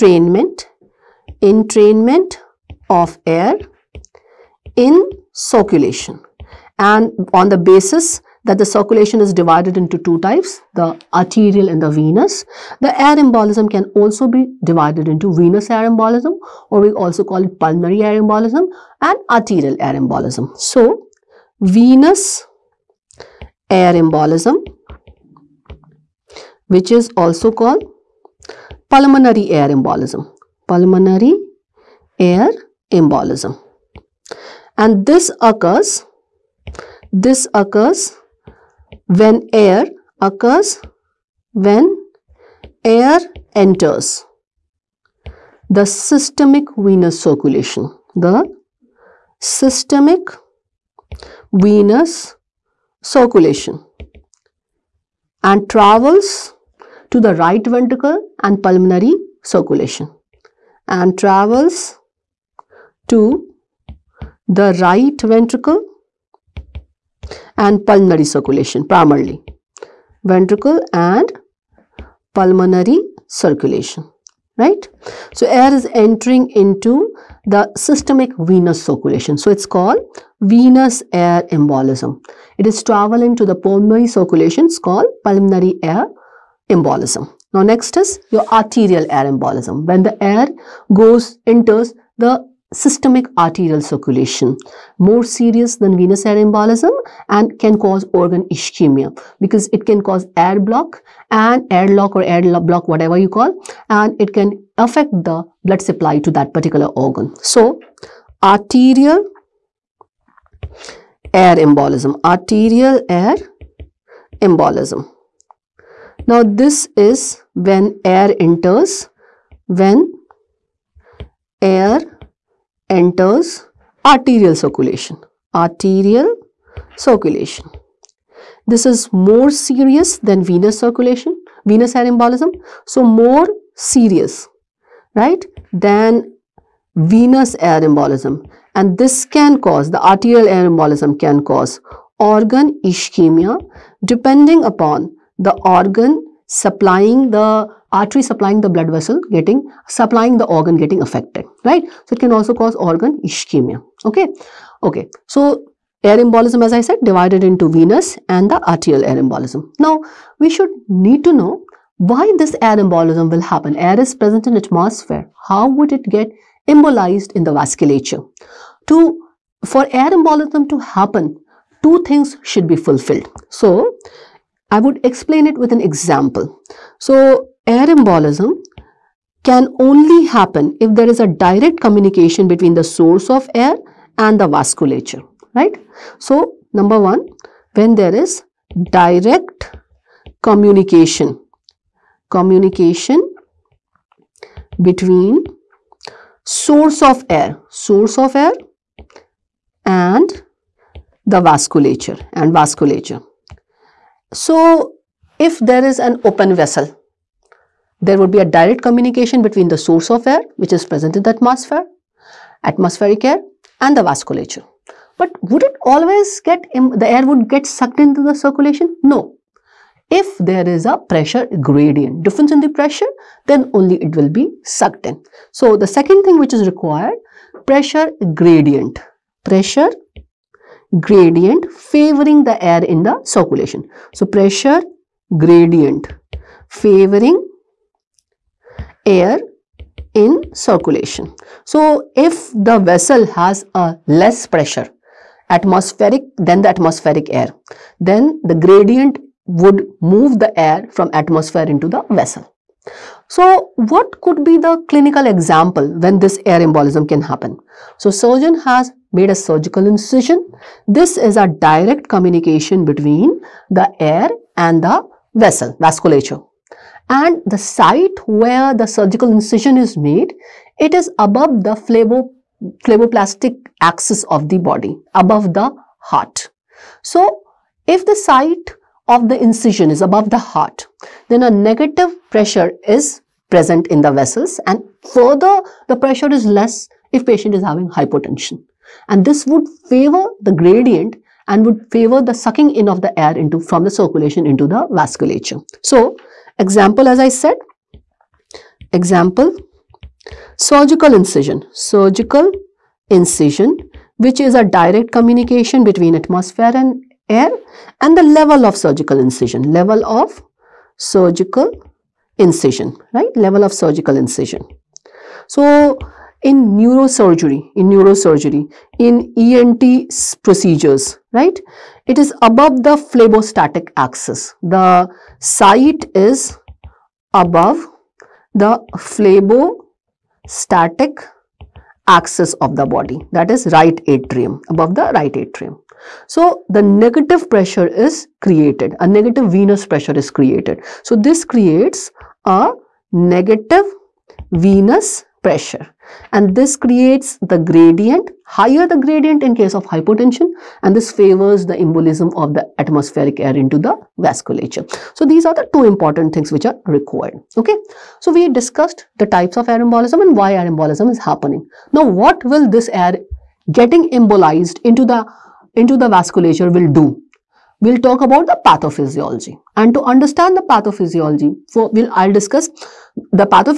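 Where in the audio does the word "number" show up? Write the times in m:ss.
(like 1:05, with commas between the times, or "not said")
3:06.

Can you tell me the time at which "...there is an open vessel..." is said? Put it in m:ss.
3:25.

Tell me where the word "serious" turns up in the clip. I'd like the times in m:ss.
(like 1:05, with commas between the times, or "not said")
1:35, 2:09, 2:13.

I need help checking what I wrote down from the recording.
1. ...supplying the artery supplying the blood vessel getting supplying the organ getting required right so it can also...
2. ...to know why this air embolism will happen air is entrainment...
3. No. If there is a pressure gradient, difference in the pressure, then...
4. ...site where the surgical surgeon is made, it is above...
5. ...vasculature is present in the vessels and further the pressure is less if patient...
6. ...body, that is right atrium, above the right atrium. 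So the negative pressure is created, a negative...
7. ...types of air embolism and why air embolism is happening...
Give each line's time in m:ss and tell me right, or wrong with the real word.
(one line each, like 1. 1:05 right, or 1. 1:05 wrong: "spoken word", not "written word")
1. 2:26 wrong: "affected", not "required"
2. 2:41 wrong: "present", not "entrainment"
3. 3:39 right
4. 4:27 wrong: "incision", not "surgeon"
5. 4:42 wrong: "pressure", not "vasculature"
6. 5:32 right
7. 5:59 right.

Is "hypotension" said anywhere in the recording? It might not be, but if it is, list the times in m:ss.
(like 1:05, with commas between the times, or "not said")
4:47, 5:49.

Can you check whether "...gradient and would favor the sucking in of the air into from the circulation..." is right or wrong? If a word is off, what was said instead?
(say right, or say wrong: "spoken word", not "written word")
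right.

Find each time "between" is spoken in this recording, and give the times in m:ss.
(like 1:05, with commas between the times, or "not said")
3:02, 3:14, 3:29, 4:22, 5:05.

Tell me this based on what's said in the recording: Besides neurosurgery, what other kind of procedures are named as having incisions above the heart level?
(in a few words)
ENT procedures.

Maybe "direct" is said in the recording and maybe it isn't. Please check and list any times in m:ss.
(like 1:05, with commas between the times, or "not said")
3:01, 3:08, 3:28, 4:21, 5:04.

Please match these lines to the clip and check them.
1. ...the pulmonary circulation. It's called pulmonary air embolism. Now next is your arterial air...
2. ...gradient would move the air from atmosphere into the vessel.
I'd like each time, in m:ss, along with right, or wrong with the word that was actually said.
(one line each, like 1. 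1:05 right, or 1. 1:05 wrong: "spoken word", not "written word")
1. 1:23 right
2. 4:08 right.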